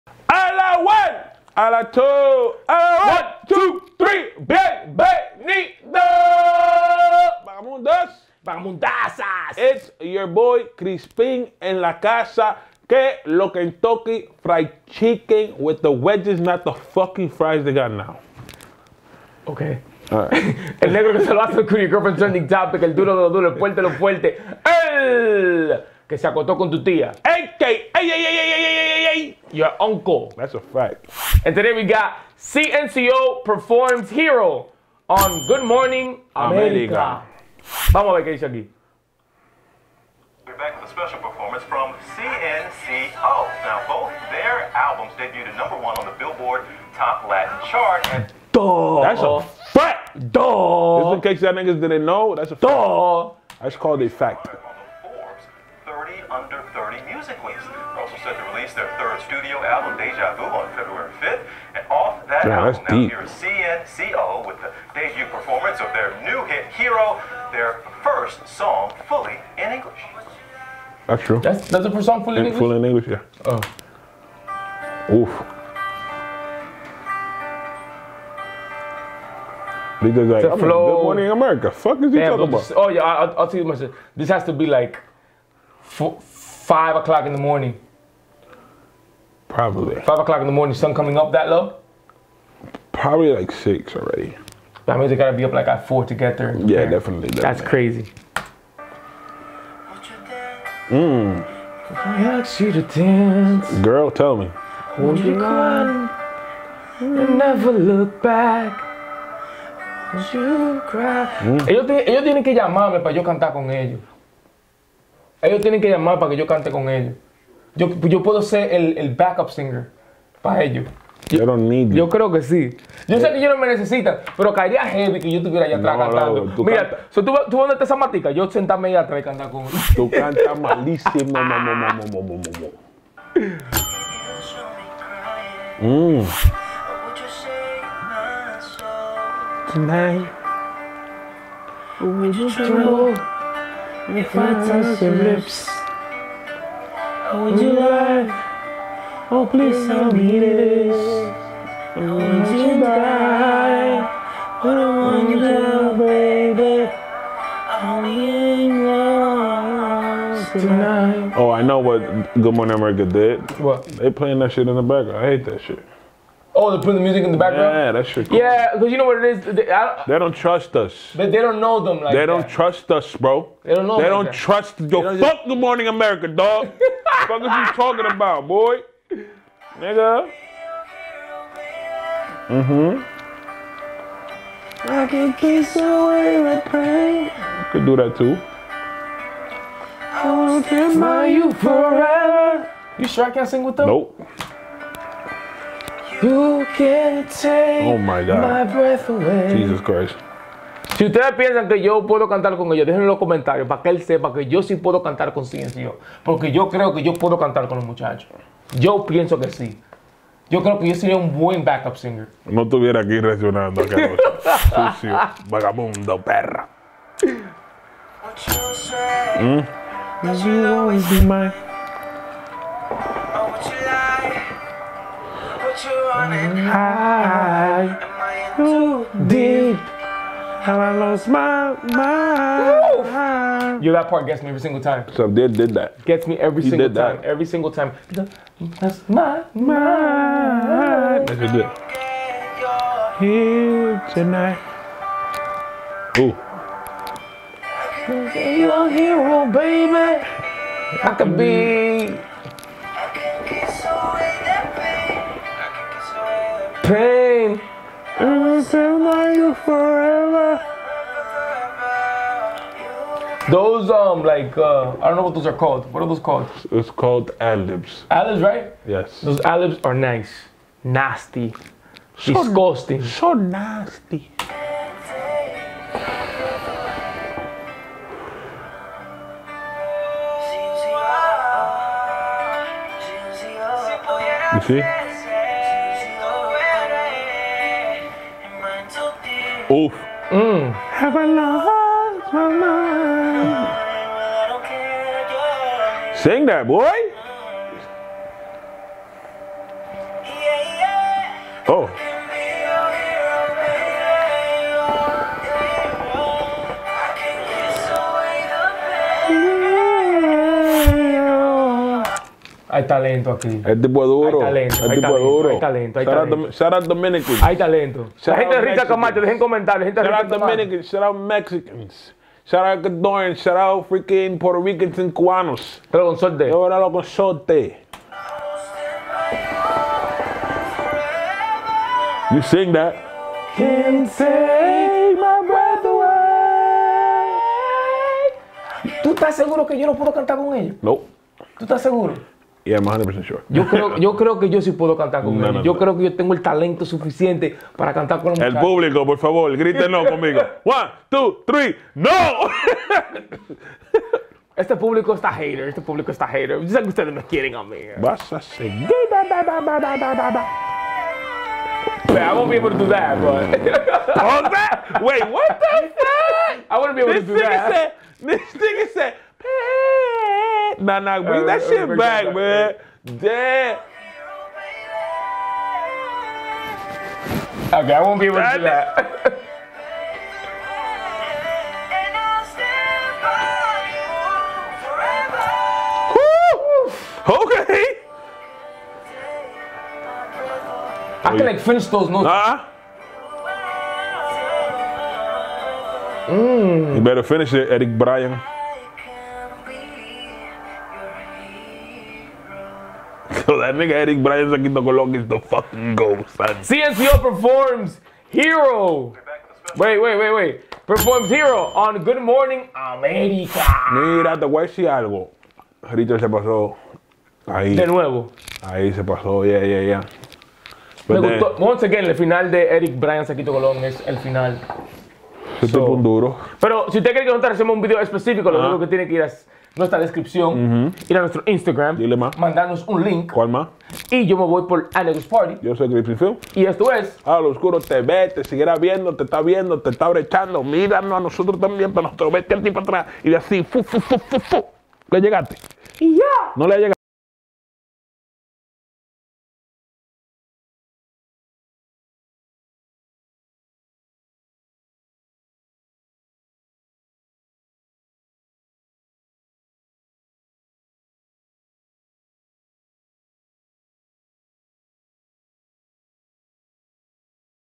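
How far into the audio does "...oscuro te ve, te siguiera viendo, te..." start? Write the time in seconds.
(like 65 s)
437 s.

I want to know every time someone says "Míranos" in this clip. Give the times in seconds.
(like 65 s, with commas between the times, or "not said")
440 s.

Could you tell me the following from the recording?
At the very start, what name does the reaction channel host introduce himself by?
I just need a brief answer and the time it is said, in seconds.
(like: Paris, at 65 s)
Crispin, at 10 s.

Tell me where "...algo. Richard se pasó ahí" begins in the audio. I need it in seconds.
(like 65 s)
414 s.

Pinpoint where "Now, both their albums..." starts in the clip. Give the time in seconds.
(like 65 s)
43 s.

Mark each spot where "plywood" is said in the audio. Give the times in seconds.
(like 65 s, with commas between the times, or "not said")
not said.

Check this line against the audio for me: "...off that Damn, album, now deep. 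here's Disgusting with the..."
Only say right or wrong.
wrong.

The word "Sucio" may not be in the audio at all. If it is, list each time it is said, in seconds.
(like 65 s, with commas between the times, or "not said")
214 s.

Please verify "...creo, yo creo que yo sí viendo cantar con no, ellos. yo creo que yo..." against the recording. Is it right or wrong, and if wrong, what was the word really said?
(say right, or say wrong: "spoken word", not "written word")
wrong: "puedo", not "viendo".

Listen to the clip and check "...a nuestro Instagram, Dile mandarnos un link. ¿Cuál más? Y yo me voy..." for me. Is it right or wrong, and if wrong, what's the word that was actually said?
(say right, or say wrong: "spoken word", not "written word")
right.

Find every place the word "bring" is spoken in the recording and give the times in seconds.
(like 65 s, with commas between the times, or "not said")
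371 s.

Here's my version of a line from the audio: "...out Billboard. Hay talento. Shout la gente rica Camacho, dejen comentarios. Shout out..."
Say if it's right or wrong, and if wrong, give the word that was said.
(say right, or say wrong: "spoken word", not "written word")
wrong: "Dominicans", not "Billboard".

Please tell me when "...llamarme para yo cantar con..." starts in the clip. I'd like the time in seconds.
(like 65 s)
112 s.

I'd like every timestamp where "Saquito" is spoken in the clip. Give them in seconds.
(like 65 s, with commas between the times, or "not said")
404 s, 423 s.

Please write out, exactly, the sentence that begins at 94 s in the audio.
That means they gotta be up like at four to get there.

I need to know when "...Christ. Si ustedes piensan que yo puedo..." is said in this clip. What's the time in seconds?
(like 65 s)
199 s.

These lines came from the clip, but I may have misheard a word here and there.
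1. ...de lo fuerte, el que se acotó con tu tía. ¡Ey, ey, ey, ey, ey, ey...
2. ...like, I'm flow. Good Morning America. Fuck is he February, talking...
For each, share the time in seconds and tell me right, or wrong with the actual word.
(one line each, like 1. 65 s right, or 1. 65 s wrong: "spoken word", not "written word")
1. 23 s right
2. 80 s wrong: "Damn", not "February".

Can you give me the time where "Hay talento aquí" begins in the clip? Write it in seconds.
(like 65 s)
312 s.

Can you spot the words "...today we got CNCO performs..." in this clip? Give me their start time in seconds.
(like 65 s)
31 s.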